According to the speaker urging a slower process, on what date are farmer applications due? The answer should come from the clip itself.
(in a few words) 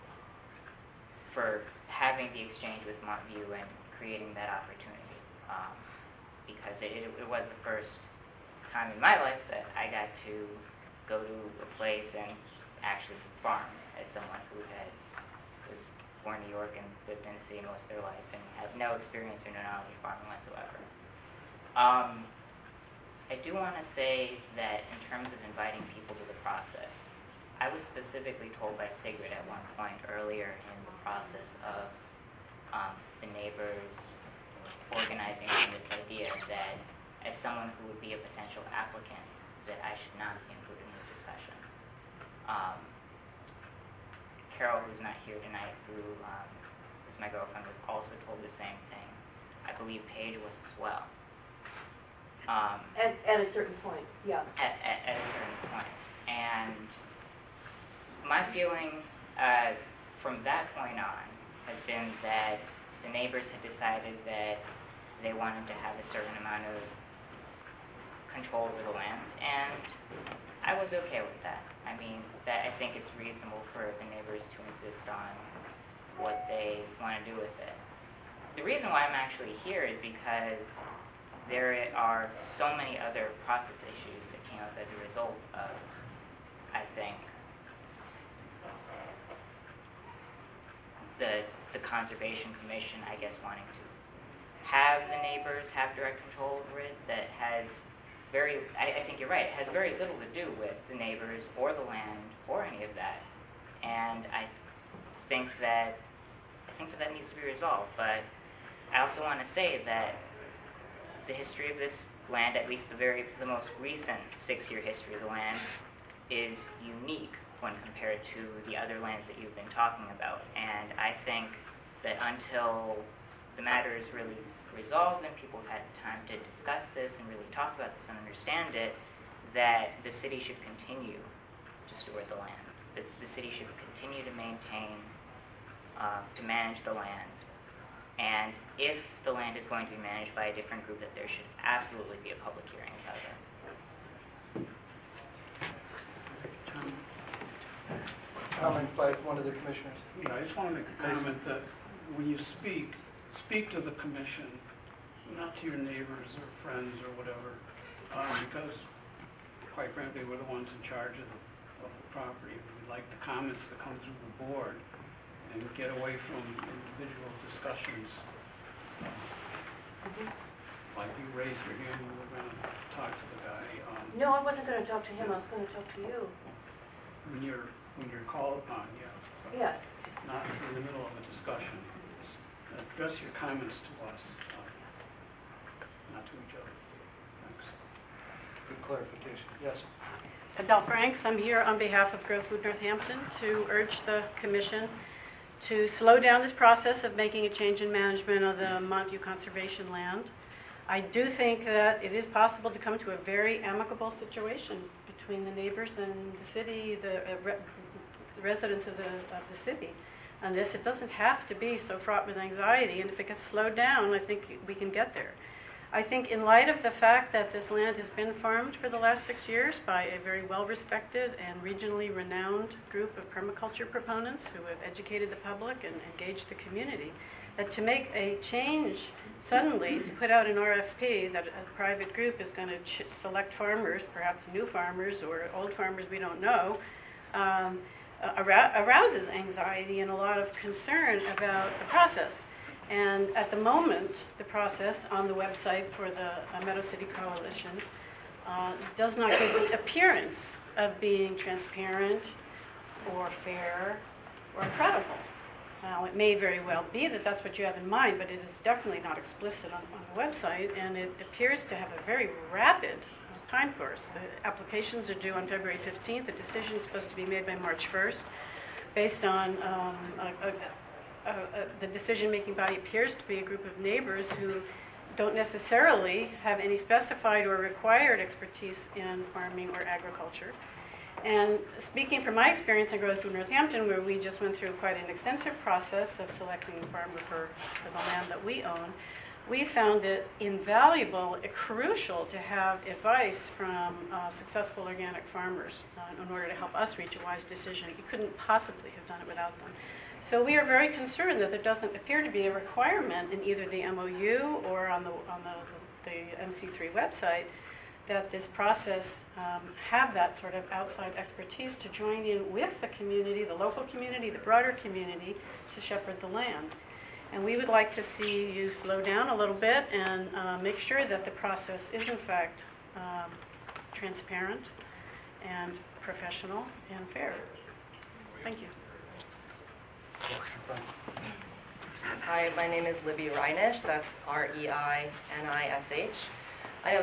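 February 15.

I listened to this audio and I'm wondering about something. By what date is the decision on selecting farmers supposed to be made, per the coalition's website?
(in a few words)
March 1.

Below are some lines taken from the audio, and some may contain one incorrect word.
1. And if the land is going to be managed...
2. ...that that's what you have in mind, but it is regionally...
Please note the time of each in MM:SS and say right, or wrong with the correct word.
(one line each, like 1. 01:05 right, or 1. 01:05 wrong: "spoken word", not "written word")
1. 02:18 right
2. 04:17 wrong: "definitely", not "regionally".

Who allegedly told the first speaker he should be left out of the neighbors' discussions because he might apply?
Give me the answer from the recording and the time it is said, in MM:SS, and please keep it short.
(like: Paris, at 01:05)
Sigrid, at 00:28.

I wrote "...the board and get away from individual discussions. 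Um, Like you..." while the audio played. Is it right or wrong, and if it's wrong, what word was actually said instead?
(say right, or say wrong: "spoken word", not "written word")
right.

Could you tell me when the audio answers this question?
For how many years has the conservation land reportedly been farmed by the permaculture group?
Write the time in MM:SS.
03:39.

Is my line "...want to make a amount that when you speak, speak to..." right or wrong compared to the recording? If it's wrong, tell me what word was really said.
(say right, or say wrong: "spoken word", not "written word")
wrong: "comment", not "amount".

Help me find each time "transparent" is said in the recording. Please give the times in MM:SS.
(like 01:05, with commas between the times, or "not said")
04:11, 05:23.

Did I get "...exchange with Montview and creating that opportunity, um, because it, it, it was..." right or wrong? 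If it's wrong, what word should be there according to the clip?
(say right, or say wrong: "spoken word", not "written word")
right.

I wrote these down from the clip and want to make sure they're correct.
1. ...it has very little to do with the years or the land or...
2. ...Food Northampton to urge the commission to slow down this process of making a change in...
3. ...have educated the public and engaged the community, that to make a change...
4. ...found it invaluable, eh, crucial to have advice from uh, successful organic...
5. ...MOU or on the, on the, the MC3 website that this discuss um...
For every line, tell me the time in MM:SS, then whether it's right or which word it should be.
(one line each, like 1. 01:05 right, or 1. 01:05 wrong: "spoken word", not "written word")
1. 01:39 wrong: "neighbors", not "years"
2. 03:12 right
3. 03:44 right
4. 04:49 right
5. 05:03 wrong: "process", not "discuss".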